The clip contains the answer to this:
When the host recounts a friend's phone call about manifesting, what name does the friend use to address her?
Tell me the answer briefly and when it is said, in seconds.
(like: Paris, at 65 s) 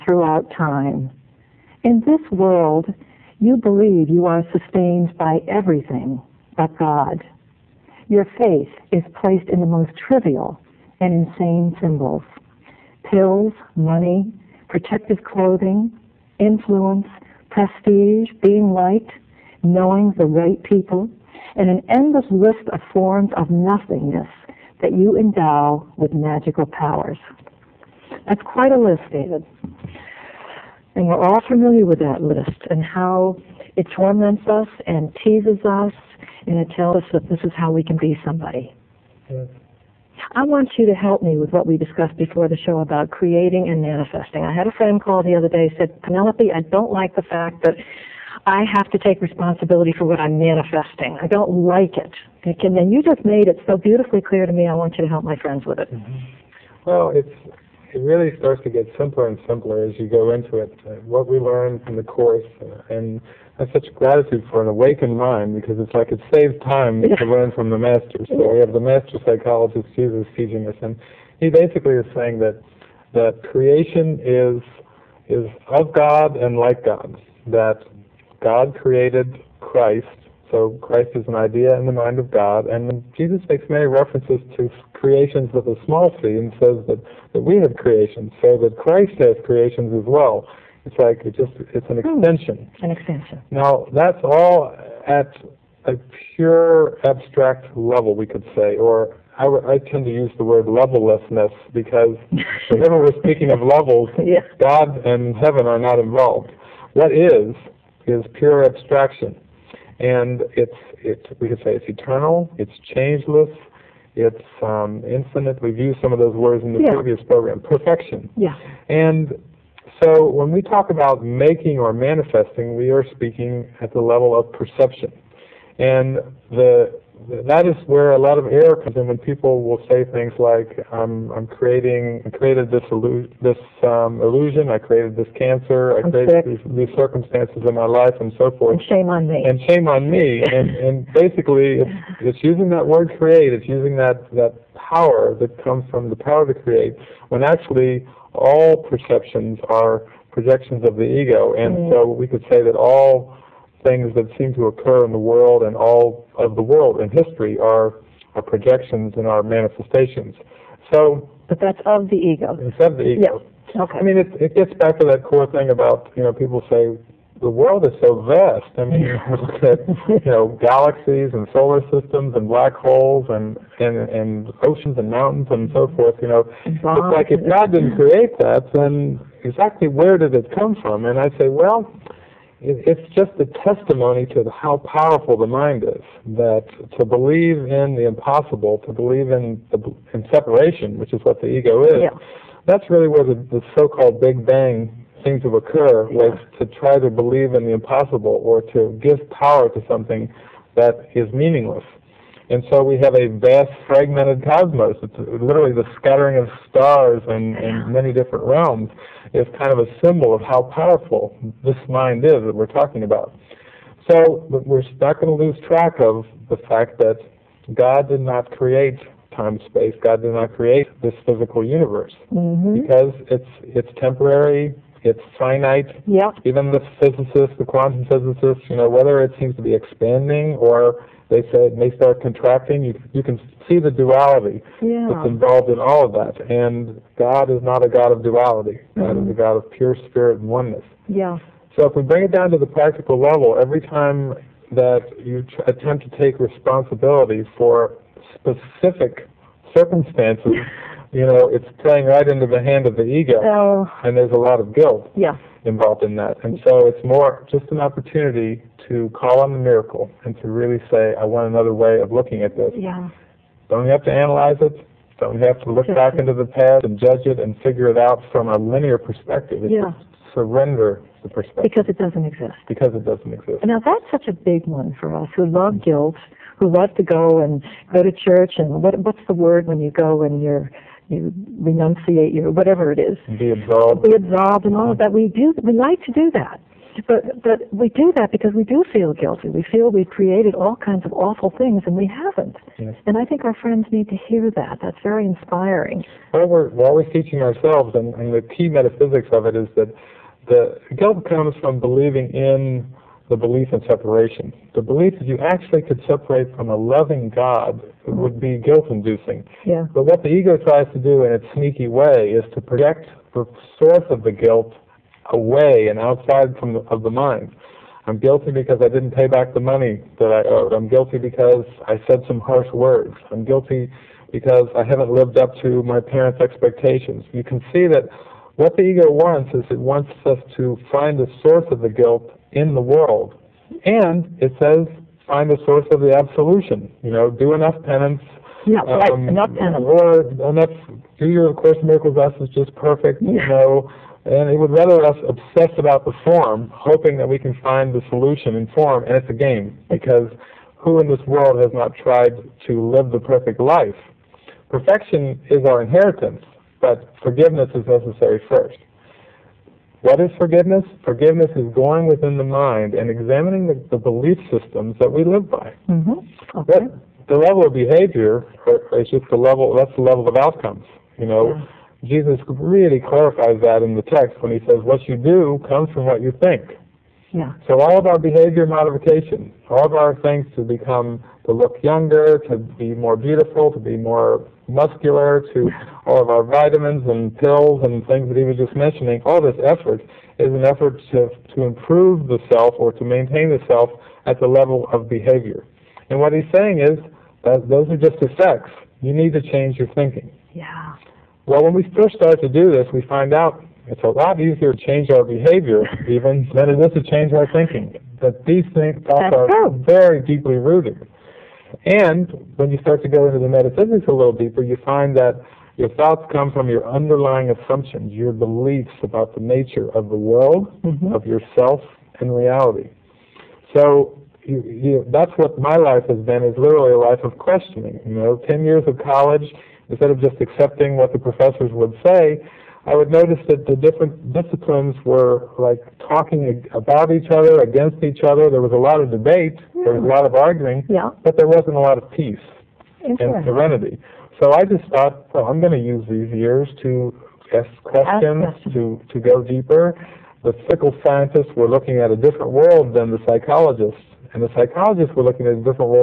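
Penelope, at 46 s.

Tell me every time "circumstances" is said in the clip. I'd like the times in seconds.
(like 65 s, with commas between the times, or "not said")
136 s, 249 s.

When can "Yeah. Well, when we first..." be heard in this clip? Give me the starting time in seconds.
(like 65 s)
400 s.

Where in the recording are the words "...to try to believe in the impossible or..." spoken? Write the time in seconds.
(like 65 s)
196 s.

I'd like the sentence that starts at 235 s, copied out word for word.
that's involved in all of that.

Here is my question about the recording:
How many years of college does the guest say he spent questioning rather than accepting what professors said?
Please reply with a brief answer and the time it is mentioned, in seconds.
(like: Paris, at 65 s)
10, at 428 s.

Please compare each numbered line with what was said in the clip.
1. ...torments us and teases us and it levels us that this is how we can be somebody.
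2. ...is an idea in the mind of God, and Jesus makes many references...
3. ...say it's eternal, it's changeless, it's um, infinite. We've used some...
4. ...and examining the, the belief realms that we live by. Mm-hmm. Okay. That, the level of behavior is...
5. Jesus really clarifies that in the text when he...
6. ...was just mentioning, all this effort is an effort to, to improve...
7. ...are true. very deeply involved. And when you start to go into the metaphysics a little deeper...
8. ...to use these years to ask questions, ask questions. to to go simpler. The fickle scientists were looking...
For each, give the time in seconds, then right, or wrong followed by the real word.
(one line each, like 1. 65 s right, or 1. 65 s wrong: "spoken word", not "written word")
1. 33 s wrong: "tells", not "levels"
2. 81 s right
3. 111 s right
4. 362 s wrong: "systems", not "realms"
5. 372 s right
6. 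388 s right
7. 409 s wrong: "rooted", not "involved"
8. 445 s wrong: "deeper", not "simpler".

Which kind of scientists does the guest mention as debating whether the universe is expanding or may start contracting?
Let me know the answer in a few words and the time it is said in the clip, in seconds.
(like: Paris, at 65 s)
quantum physicists, at 227 s.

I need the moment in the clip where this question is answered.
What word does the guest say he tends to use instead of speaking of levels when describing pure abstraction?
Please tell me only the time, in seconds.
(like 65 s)
100 s.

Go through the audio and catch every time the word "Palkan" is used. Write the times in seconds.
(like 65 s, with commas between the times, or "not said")
not said.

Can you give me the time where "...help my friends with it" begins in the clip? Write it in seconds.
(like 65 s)
55 s.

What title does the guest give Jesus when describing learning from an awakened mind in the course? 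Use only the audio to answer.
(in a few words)
master psychologist.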